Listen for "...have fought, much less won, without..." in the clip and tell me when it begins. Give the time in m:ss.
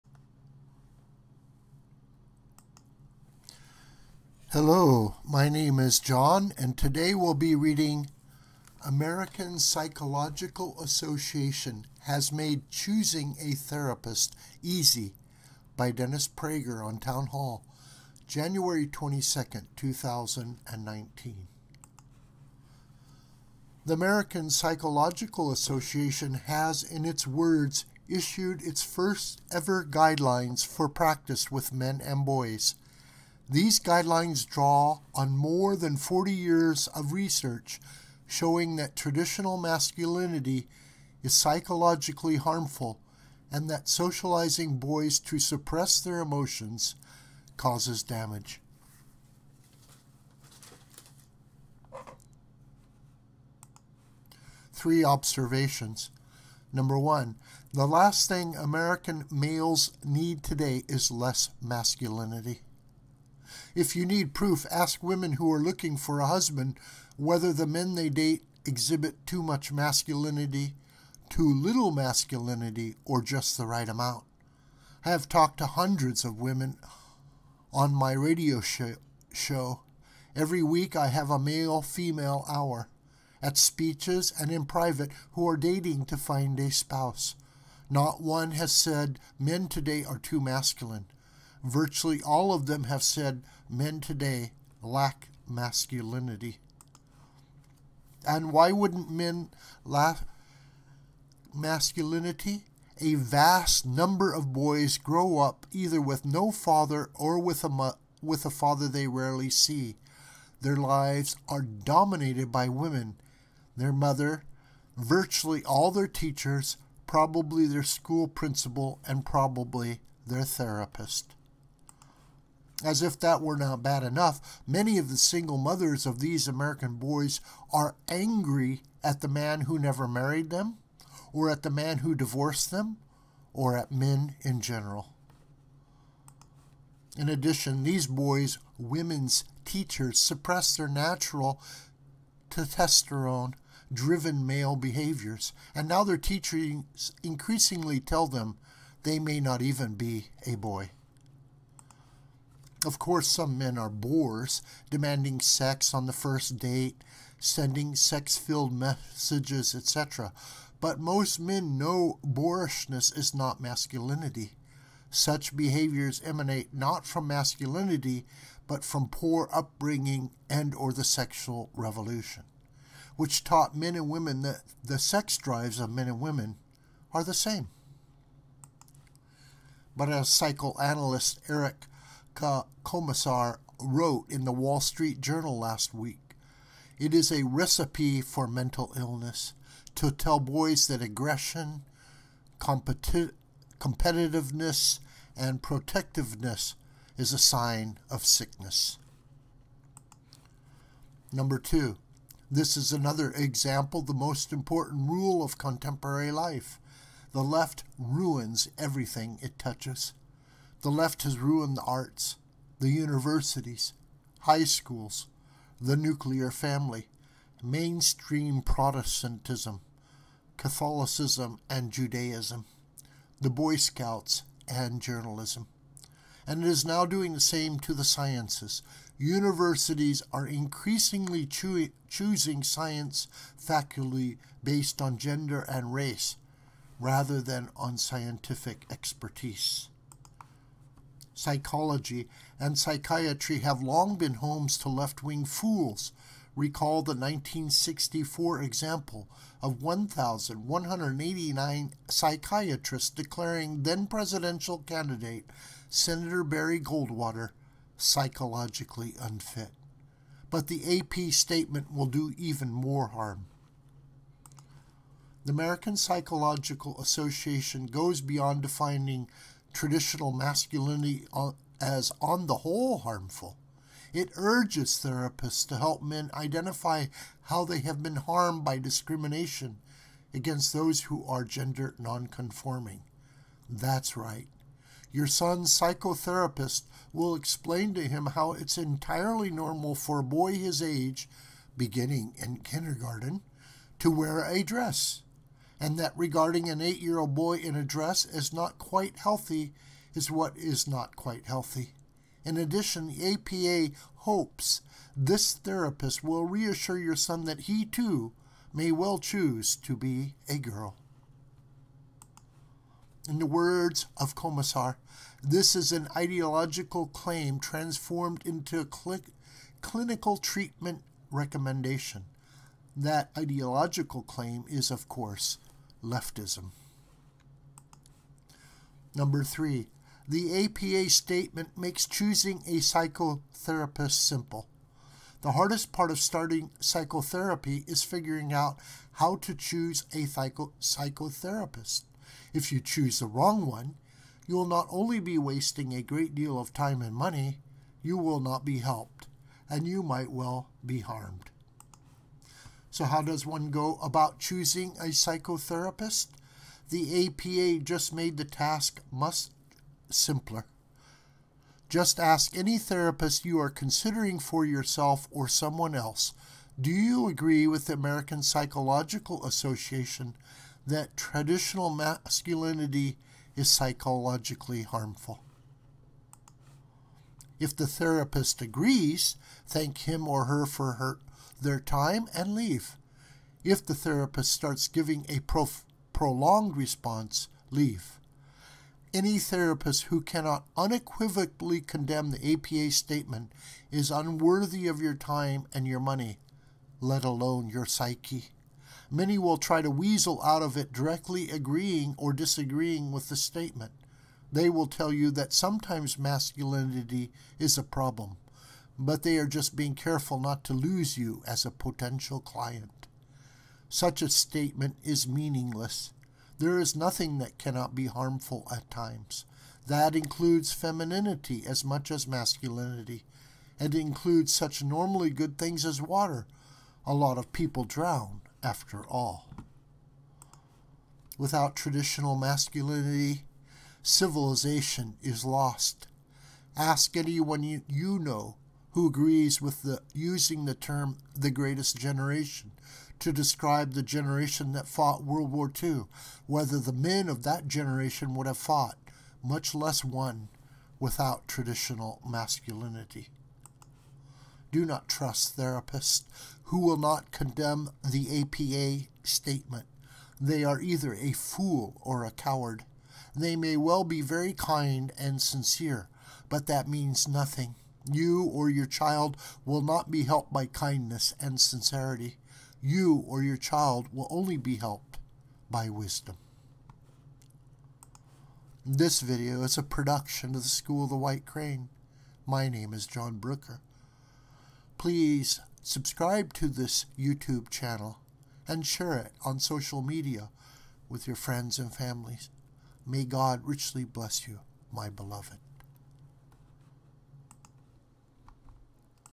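7:28.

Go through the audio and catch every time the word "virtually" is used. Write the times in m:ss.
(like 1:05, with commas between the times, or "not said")
1:31, 1:54.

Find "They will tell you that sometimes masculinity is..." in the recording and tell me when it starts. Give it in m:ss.
6:44.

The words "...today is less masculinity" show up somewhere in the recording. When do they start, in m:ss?
1:00.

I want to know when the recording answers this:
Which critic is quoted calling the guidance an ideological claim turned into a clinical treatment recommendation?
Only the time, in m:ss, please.
5:14.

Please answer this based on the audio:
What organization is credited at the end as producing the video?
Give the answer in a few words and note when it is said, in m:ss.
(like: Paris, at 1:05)
School of the White Crane, at 8:00.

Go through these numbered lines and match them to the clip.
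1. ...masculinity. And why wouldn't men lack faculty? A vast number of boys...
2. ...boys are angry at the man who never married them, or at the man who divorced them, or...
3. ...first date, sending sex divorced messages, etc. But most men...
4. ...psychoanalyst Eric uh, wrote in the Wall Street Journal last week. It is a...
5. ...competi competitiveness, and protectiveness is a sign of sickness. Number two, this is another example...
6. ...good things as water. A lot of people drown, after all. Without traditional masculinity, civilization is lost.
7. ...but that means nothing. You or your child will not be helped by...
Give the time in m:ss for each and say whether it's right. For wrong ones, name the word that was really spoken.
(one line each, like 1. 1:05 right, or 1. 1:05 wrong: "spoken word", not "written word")
1. 1:35 wrong: "masculinity", not "faculty"
2. 2:06 right
3. 2:36 wrong: "filled", not "divorced"
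4. 3:00 right
5. 3:12 right
6. 7:05 right
7. 7:46 right.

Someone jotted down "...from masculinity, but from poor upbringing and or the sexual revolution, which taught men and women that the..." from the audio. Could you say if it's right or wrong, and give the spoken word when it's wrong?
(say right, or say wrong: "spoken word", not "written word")
right.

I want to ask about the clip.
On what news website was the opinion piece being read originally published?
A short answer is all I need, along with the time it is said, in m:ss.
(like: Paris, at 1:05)
Townhall, at 0:16.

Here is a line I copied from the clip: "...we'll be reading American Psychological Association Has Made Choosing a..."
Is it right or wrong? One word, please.
right.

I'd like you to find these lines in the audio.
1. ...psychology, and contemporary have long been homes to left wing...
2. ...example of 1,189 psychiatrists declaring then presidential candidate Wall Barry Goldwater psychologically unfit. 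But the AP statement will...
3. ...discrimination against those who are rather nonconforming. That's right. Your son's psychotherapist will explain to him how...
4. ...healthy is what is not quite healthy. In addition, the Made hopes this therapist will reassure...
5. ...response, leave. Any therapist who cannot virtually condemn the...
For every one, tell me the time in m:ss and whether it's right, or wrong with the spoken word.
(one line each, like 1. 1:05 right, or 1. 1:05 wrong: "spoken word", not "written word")
1. 4:01 wrong: "psychiatry", not "contemporary"
2. 4:08 wrong: "Senator", not "Wall"
3. 4:38 wrong: "gender", not "rather"
4. 4:59 wrong: "APA", not "Made"
5. 6:26 wrong: "unequivocally", not "virtually".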